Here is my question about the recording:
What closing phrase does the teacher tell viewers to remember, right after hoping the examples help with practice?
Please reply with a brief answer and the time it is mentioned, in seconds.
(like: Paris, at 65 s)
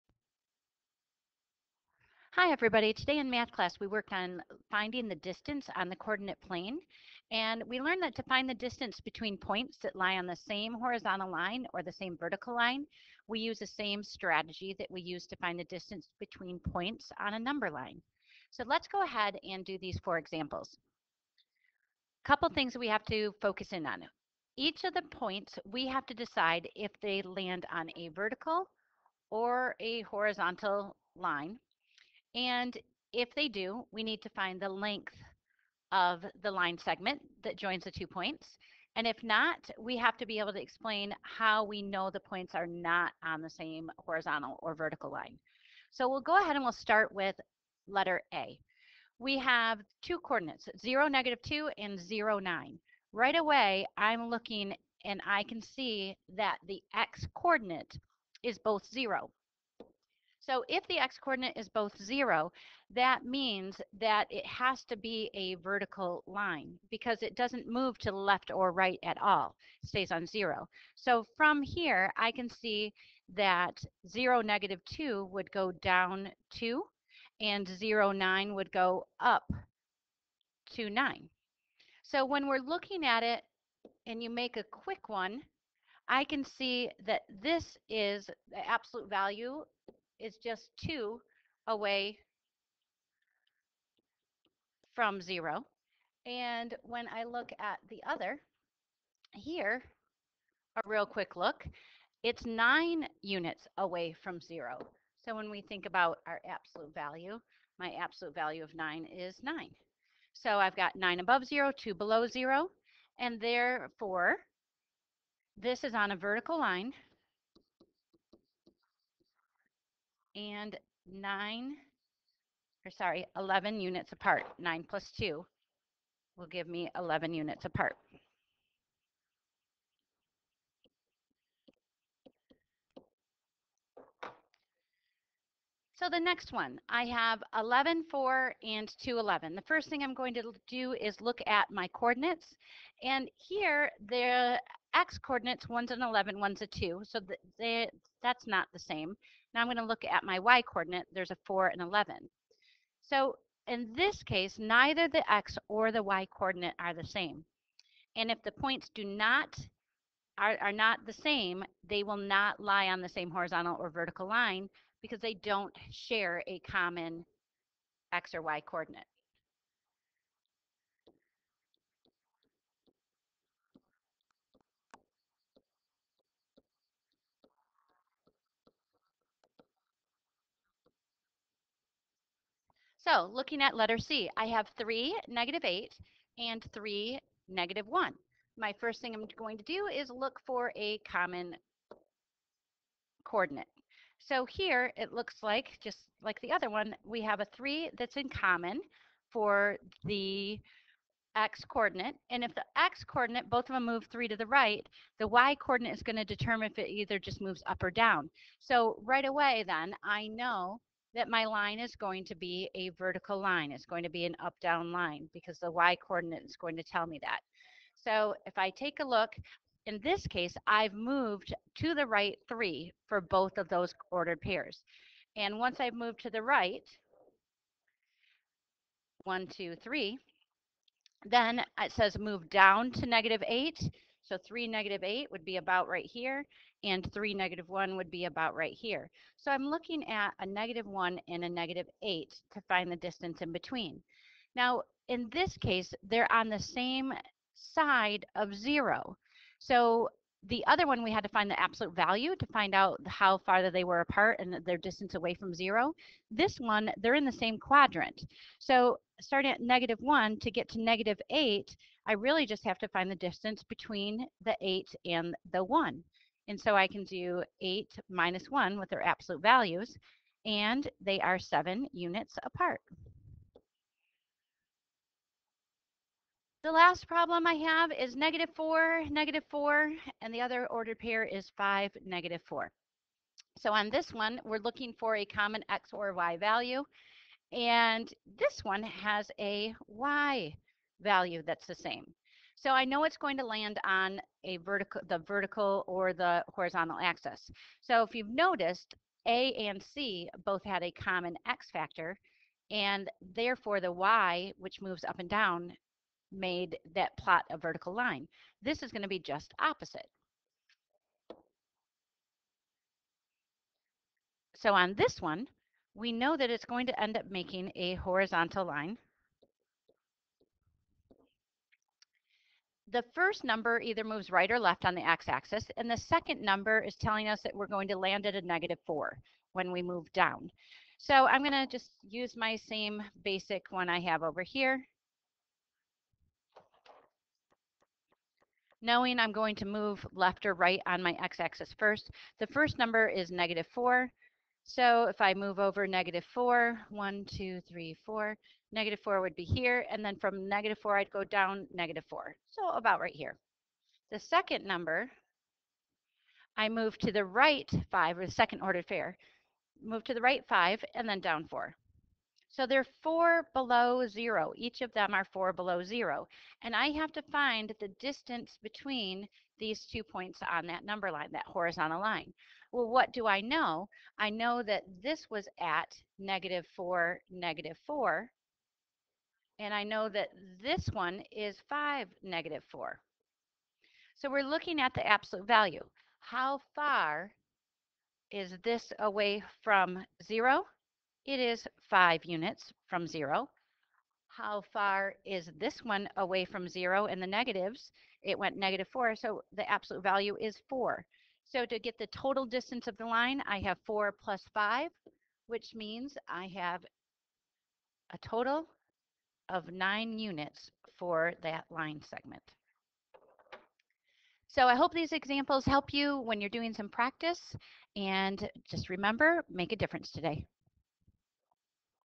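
make a difference today, at 419 s.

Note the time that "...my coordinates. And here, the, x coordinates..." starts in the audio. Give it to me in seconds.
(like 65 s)
141 s.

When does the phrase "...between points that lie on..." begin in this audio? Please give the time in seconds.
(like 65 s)
9 s.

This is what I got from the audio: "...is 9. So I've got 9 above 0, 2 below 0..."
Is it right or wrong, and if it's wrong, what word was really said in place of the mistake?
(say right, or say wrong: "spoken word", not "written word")
right.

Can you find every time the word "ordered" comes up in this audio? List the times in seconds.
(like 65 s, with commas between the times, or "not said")
224 s, 280 s, 358 s.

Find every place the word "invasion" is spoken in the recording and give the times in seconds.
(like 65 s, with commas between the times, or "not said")
not said.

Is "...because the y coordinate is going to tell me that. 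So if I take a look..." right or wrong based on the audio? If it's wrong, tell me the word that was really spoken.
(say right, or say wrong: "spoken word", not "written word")
right.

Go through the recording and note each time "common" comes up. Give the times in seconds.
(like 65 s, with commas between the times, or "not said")
166 s, 190 s, 198 s, 285 s, 300 s.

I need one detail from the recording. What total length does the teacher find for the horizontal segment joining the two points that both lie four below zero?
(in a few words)
9 units.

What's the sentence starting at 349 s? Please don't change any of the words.
And then from negative 4, I'd go down negative 4.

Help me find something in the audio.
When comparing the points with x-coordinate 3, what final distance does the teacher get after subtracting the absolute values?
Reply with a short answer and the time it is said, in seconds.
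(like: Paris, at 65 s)
7 units, at 271 s.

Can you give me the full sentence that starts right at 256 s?
This one, they're in the same quadrant.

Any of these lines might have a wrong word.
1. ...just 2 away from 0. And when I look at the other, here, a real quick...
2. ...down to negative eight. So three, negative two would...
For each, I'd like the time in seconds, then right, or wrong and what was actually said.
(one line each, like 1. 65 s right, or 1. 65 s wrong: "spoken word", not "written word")
1. 90 s right
2. 232 s wrong: "eight", not "two".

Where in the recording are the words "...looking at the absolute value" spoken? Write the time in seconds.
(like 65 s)
384 s.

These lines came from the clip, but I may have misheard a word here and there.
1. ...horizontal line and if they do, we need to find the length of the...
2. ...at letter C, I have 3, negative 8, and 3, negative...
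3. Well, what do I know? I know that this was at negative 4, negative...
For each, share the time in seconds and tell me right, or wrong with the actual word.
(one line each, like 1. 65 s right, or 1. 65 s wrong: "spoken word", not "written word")
1. 30 s right
2. 183 s right
3. 372 s right.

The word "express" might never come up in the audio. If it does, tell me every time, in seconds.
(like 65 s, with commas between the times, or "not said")
not said.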